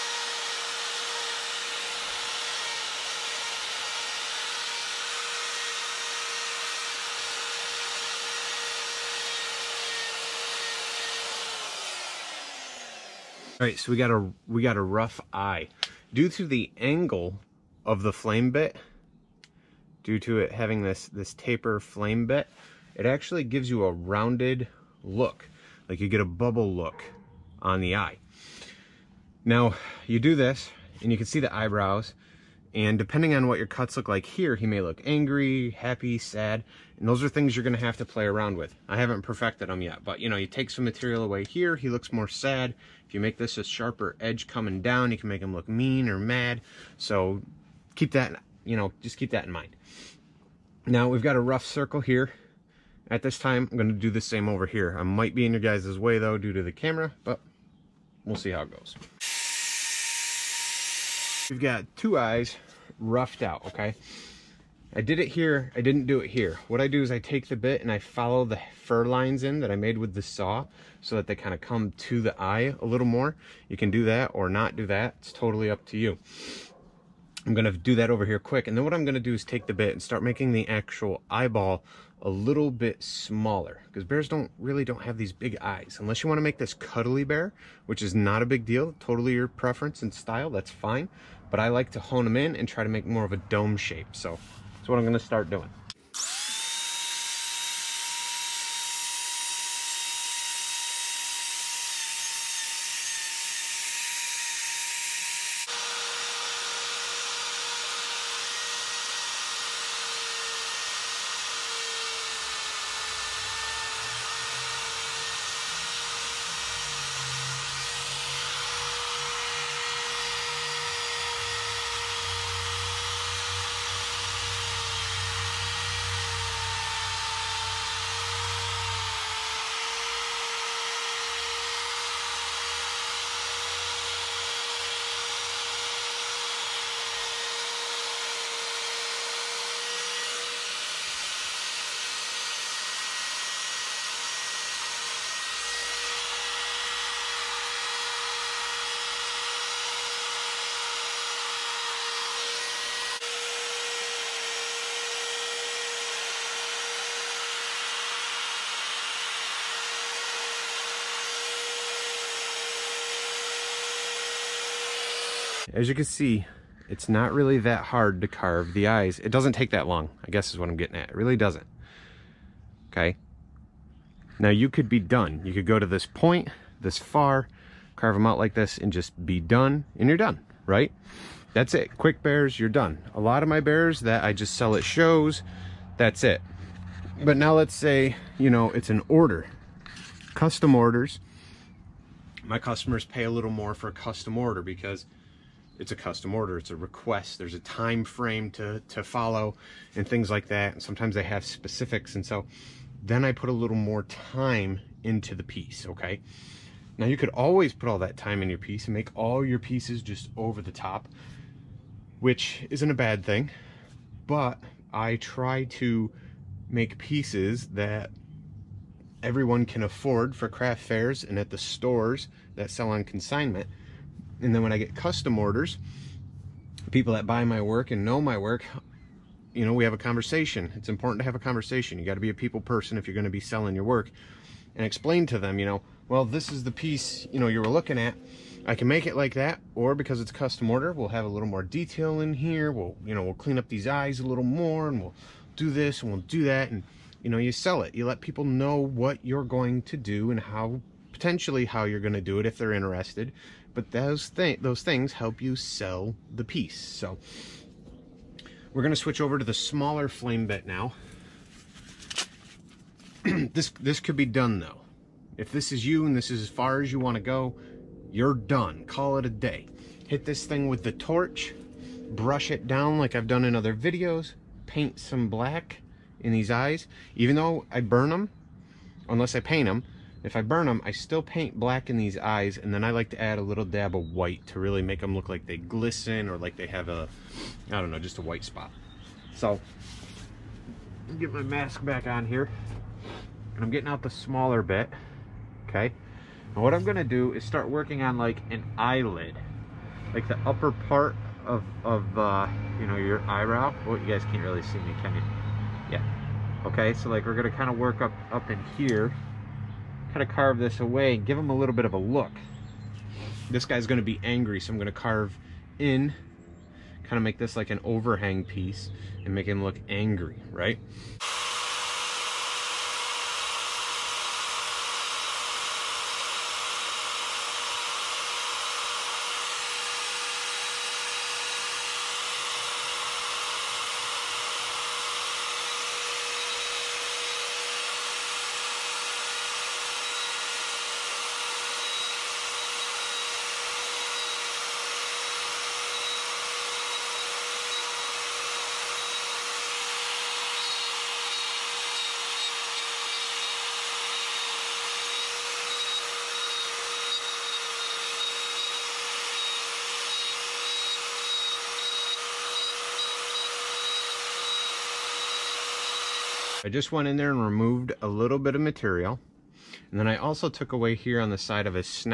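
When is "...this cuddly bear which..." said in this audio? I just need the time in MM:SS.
01:26.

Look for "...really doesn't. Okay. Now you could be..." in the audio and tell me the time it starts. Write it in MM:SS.
02:51.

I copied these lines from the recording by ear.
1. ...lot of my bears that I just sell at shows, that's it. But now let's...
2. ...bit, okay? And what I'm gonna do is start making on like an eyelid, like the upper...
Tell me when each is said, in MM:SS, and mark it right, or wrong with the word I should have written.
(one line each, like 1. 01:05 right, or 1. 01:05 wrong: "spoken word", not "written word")
1. 03:03 right
2. 04:54 wrong: "working", not "making".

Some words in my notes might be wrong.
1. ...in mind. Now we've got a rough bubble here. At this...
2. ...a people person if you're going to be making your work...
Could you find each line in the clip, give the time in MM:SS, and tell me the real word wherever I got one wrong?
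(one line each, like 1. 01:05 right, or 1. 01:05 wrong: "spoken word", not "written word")
1. 00:49 wrong: "circle", not "bubble"
2. 03:52 wrong: "selling", not "making".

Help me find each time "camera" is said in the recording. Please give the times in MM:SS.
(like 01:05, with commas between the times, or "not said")
00:56.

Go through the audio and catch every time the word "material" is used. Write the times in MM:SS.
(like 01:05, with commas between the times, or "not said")
00:40, 06:08.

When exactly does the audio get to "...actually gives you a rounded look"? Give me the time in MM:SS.
00:23.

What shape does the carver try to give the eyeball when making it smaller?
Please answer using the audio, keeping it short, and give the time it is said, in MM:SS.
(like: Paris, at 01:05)
dome shape, at 01:33.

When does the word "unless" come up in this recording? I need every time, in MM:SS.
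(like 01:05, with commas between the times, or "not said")
01:25, 04:39.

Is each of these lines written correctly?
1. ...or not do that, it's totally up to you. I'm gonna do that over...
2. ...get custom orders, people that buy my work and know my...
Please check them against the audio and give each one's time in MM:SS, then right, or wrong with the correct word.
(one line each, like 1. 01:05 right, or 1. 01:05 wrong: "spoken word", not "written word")
1. 01:14 right
2. 03:44 right.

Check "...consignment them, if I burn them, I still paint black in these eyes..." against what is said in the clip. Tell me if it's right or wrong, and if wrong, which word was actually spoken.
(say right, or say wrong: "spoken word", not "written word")
wrong: "paint", not "consignment".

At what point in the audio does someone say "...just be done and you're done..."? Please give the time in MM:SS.
02:58.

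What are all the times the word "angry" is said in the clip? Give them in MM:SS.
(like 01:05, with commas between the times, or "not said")
00:35, 05:14, 05:19.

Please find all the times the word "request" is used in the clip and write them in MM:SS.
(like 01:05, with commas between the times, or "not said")
03:16.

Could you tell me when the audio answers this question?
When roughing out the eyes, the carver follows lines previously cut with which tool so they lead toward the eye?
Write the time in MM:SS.
01:10.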